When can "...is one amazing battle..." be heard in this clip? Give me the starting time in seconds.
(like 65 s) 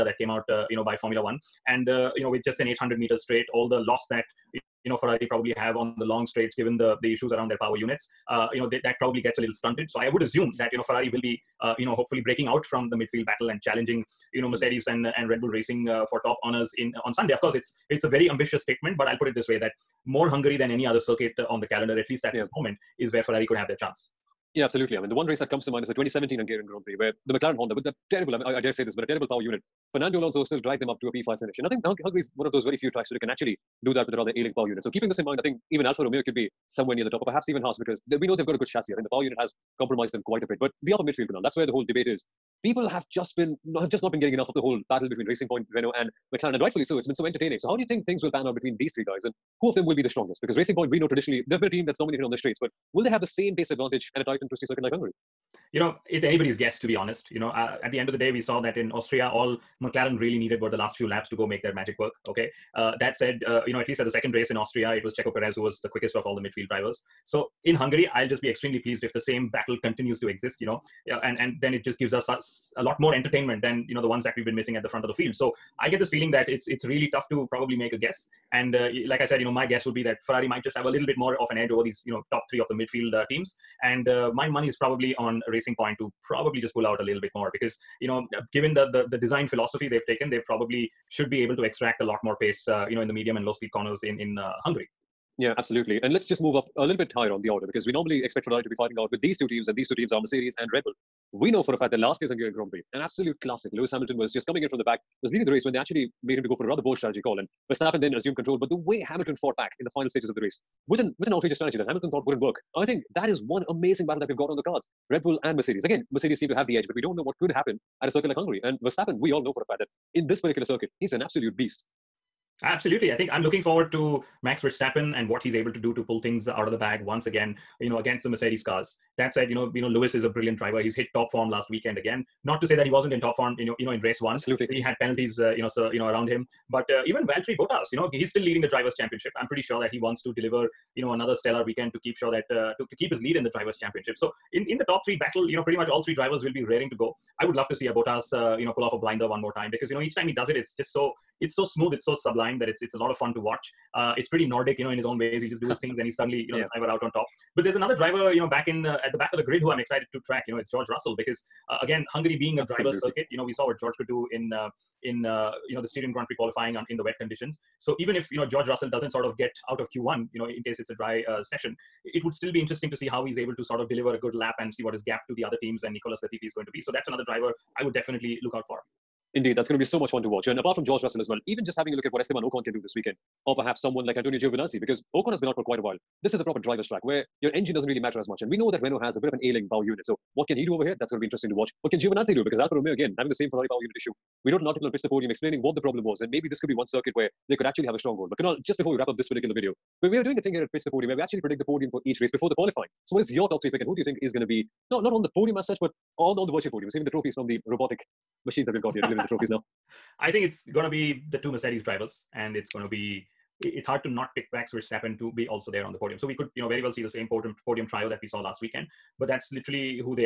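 113 s.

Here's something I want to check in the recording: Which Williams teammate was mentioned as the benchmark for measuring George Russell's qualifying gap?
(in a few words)
Nicolas Latifi.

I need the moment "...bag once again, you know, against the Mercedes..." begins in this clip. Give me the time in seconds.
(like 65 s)
126 s.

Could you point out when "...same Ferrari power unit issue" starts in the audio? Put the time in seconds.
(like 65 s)
193 s.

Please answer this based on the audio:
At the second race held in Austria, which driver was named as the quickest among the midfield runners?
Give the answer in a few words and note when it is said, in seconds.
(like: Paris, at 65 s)
Checo Perez, at 65 s.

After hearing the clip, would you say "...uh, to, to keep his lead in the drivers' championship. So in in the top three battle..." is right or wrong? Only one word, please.
right.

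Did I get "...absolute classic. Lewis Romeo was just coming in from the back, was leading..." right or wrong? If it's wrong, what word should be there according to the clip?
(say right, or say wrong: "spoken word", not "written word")
wrong: "Hamilton", not "Romeo".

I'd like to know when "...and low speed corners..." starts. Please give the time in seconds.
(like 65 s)
93 s.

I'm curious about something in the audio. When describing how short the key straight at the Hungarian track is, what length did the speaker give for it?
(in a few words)
800 meters.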